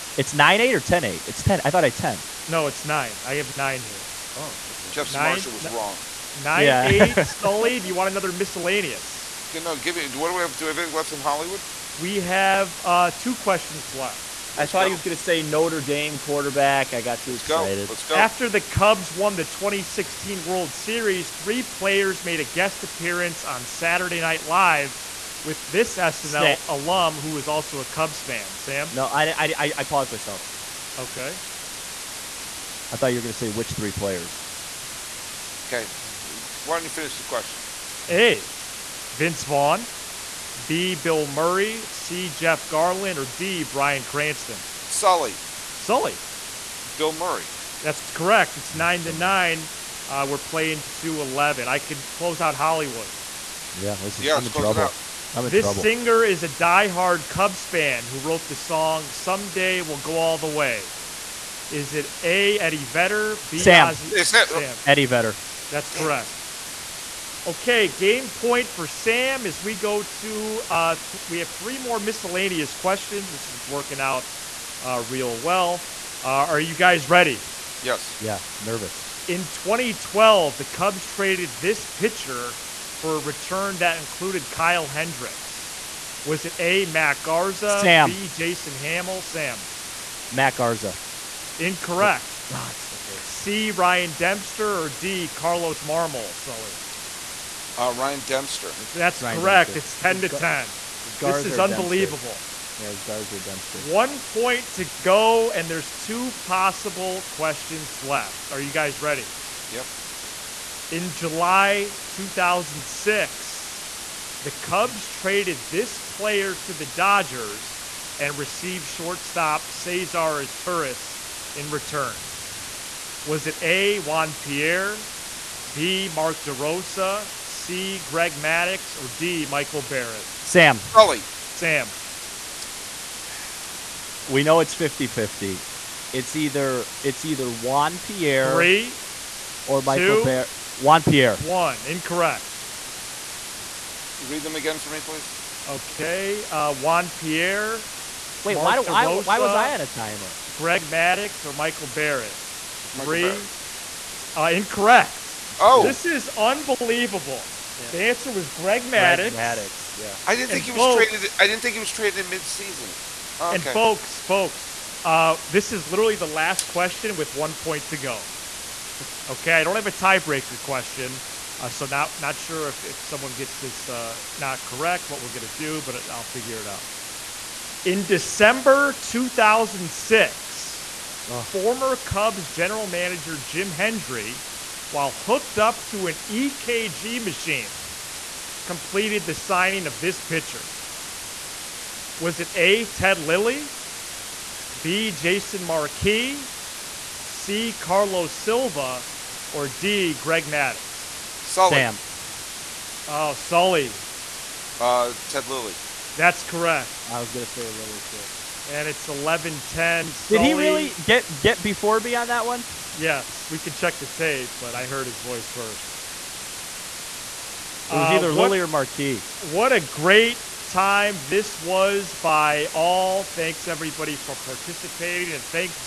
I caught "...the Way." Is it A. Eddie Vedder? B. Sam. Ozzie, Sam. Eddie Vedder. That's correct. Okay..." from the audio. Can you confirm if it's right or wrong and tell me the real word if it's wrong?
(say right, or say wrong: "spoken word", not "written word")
right.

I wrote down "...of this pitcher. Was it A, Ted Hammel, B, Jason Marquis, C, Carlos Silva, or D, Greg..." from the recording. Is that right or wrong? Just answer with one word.
wrong.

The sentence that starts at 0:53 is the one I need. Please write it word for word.
Yeah, this is yeah, I'm in trouble.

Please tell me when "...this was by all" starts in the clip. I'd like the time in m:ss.
3:41.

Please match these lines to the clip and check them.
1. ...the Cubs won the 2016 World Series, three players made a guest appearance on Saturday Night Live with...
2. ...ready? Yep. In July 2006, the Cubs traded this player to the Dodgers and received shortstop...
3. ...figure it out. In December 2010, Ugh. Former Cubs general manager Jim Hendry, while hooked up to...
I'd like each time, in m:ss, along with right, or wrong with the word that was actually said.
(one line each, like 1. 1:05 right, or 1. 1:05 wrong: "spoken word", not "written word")
1. 0:18 right
2. 1:49 right
3. 2:56 wrong: "2006", not "2010".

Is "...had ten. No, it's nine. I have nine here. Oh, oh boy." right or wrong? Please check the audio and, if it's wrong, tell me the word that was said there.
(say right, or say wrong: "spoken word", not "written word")
right.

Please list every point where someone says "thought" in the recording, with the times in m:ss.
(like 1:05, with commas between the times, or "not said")
0:01, 0:14, 0:32.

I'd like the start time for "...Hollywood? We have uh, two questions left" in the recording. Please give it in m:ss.
0:11.